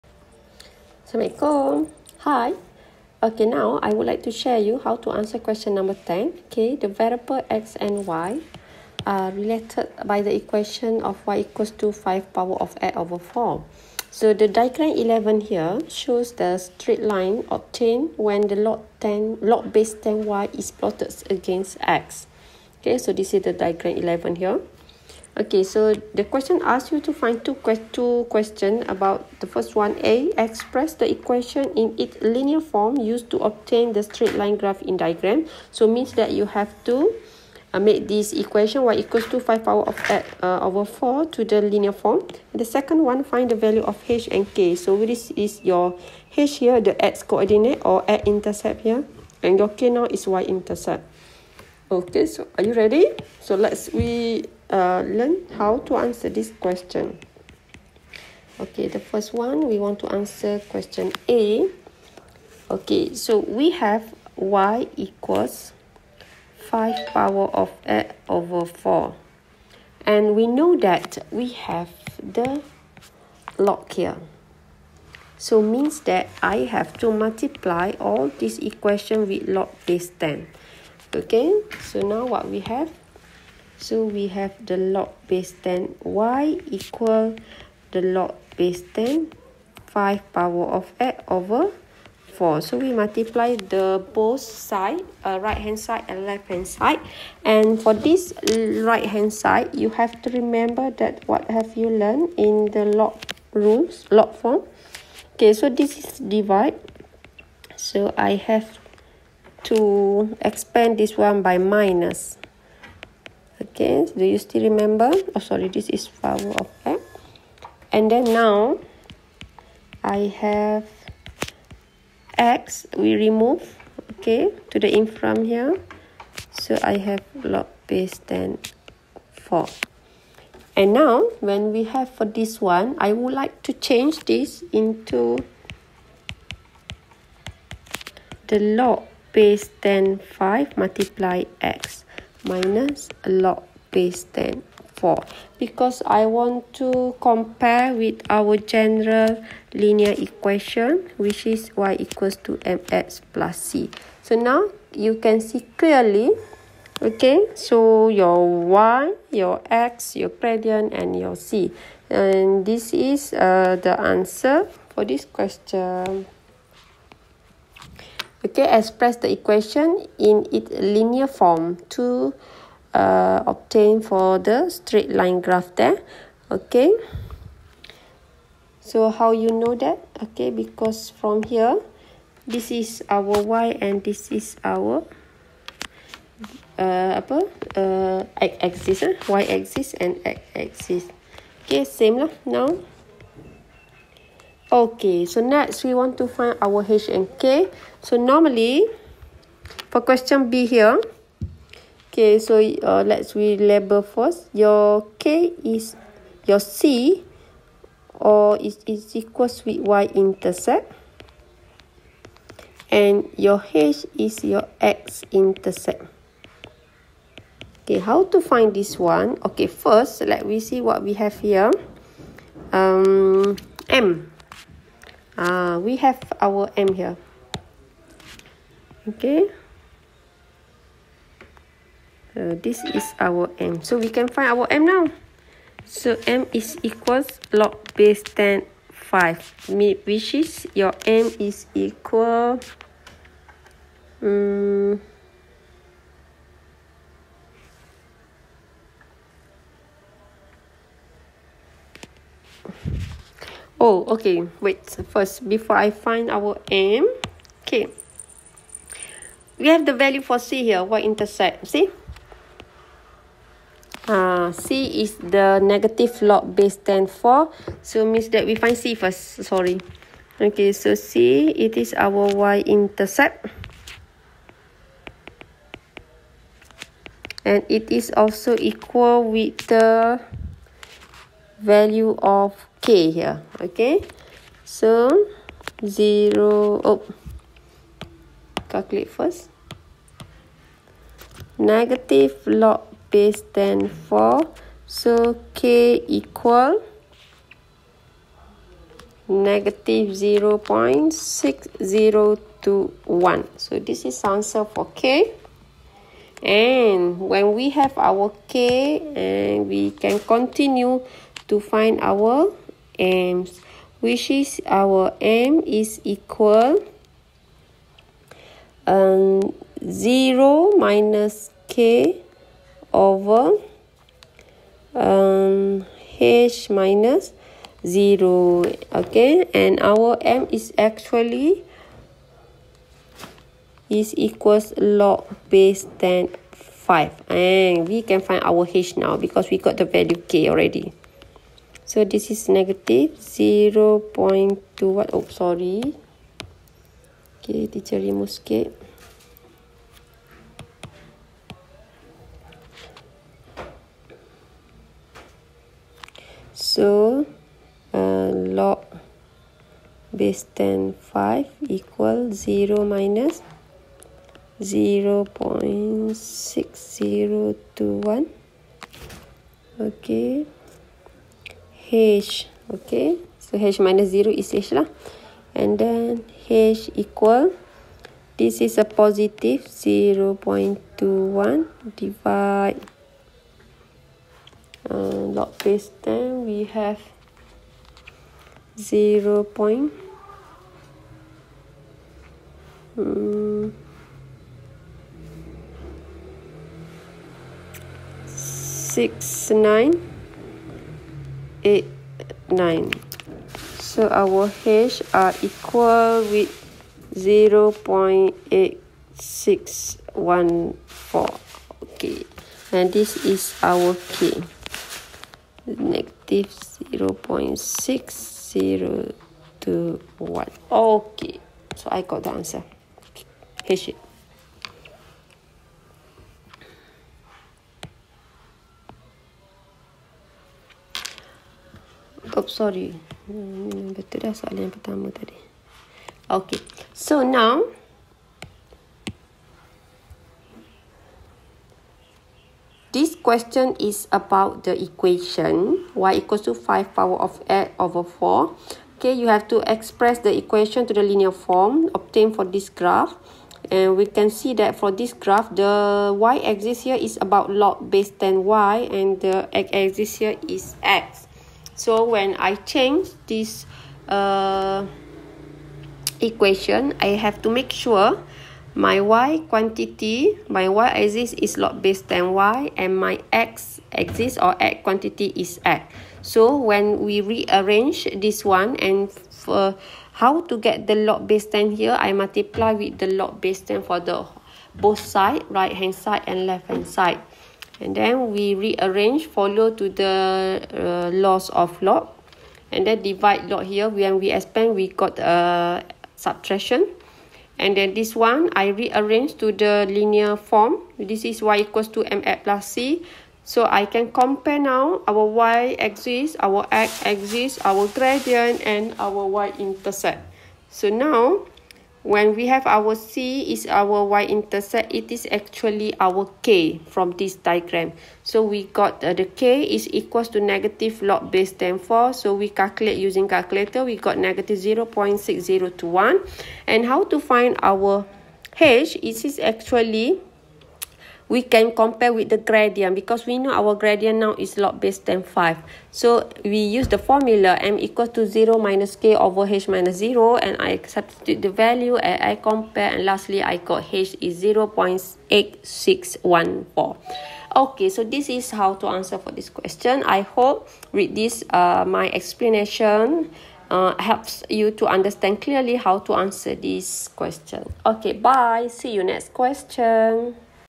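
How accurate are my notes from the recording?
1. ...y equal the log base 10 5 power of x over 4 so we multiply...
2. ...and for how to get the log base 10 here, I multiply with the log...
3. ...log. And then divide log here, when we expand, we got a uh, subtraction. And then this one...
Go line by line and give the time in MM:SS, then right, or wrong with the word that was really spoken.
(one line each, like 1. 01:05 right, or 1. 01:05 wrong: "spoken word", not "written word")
1. 01:26 right
2. 07:58 right
3. 08:11 right.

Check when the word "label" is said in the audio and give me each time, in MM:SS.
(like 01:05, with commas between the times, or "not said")
03:23.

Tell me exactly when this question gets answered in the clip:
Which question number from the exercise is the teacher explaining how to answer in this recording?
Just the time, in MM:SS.
00:05.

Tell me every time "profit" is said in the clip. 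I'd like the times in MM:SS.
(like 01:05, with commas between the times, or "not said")
not said.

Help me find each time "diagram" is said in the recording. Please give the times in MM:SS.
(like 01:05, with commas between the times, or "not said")
00:14, 00:23, 00:34, 08:37.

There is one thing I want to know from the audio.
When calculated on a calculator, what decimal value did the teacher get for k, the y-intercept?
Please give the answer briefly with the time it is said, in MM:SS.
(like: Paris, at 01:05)
-0.6021, at 04:55.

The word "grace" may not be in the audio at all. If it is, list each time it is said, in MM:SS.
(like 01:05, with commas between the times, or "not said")
not said.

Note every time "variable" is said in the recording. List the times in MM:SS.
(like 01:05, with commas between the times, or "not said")
00:06.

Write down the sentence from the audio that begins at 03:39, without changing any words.
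Okay, first, let me see what we have here.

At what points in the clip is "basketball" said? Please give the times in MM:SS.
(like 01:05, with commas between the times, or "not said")
not said.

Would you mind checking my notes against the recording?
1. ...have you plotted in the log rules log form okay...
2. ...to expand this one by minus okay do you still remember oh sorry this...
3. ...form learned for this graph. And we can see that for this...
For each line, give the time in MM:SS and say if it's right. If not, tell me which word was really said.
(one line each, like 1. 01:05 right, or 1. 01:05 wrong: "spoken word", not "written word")
1. 01:41 wrong: "learned", not "plotted"
2. 01:49 right
3. 07:31 wrong: "obtained", not "learned".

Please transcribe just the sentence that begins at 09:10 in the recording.
I hope with this uh, my explanation uh, helps you to understand clearly how to answer this question.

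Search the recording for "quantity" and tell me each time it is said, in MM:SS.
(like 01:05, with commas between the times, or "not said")
07:49, 07:54.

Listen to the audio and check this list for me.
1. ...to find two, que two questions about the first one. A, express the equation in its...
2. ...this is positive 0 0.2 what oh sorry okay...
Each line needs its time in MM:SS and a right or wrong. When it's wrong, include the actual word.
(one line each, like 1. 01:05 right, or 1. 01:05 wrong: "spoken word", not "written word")
1. 00:26 right
2. 05:42 wrong: "negative", not "positive".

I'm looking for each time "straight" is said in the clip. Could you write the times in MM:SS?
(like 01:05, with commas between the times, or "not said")
00:16, 00:34, 02:54.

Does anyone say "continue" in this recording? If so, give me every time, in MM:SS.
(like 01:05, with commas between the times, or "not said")
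05:10.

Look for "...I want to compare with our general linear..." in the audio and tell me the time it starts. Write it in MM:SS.
02:26.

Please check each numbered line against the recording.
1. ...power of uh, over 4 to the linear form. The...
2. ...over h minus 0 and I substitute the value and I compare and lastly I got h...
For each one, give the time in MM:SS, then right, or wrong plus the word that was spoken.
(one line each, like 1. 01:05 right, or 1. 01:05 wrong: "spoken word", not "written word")
1. 00:39 right
2. 08:59 right.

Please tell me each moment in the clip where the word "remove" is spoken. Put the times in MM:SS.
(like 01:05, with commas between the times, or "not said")
02:03, 05:47.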